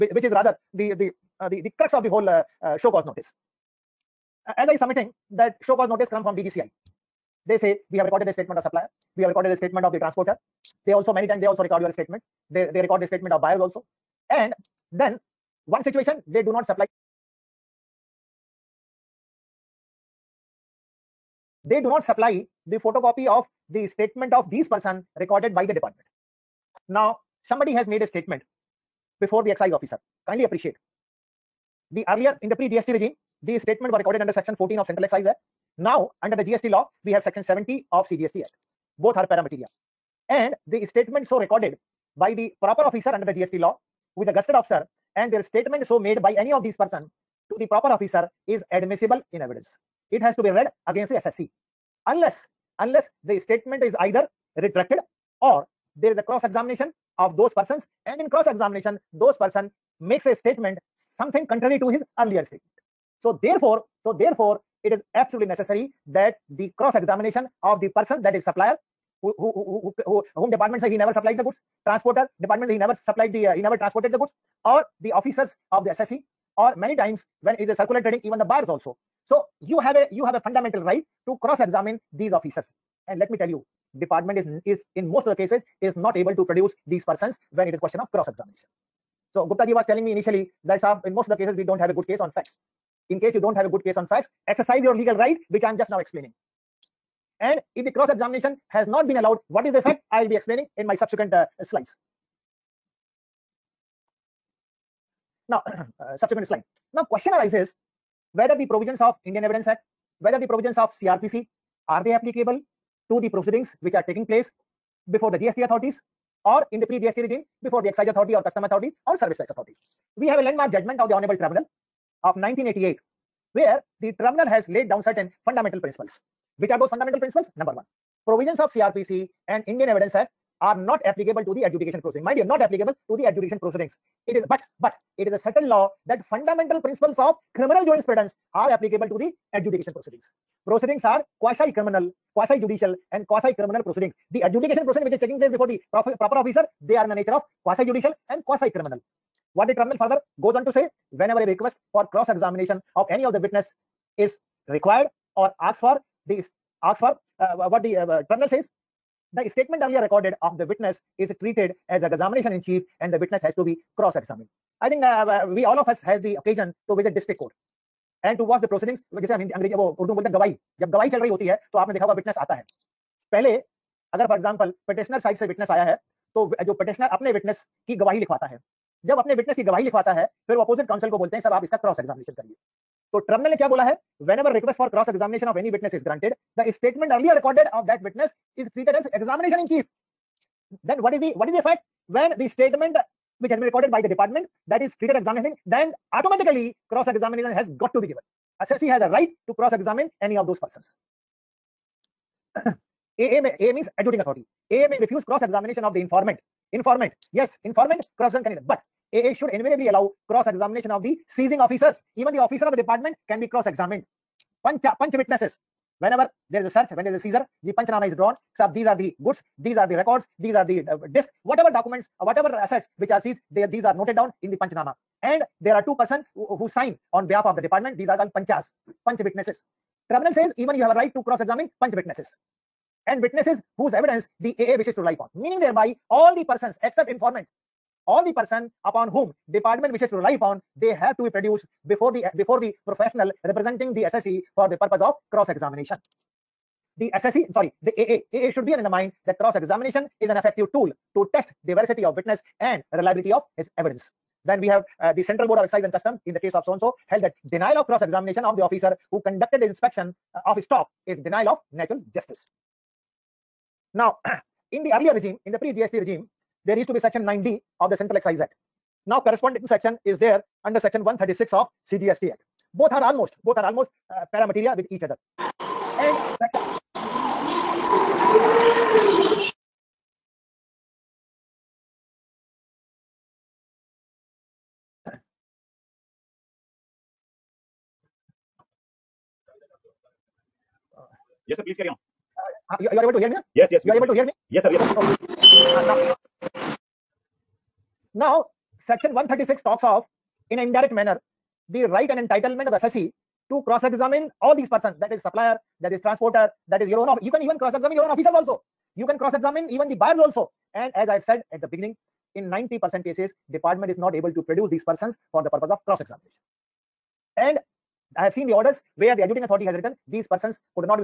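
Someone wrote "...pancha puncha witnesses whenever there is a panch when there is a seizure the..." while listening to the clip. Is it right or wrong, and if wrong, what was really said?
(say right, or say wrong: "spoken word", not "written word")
wrong: "search", not "panch".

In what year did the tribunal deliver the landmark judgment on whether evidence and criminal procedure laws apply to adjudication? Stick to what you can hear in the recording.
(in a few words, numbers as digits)
1988.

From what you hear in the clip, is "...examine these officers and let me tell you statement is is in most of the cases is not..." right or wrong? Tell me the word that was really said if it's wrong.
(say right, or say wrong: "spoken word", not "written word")
wrong: "department", not "statement".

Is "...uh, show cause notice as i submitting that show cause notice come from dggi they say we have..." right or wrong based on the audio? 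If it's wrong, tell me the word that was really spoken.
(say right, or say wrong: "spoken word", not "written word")
right.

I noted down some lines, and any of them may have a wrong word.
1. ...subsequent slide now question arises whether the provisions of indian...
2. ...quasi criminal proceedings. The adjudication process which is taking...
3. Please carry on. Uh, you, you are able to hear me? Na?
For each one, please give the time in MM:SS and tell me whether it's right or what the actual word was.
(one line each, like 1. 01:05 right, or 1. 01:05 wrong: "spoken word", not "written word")
1. 01:46 right
2. 02:23 right
3. 04:51 right.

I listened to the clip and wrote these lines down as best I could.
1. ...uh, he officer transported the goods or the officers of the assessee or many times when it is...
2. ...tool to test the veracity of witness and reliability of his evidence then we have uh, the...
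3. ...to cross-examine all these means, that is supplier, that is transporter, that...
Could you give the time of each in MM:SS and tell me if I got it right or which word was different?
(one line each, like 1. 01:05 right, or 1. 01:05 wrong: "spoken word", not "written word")
1. 01:13 wrong: "never", not "officer"
2. 04:10 right
3. 05:03 wrong: "persons", not "means".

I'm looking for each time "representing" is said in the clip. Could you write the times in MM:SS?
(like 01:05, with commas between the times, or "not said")
04:03.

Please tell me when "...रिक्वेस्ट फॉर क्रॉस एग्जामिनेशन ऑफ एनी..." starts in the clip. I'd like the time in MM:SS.
03:04.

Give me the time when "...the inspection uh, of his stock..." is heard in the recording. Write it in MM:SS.
04:19.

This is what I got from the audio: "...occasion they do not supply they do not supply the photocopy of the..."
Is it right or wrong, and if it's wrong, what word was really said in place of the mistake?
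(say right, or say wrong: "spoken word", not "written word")
wrong: "situation", not "occasion".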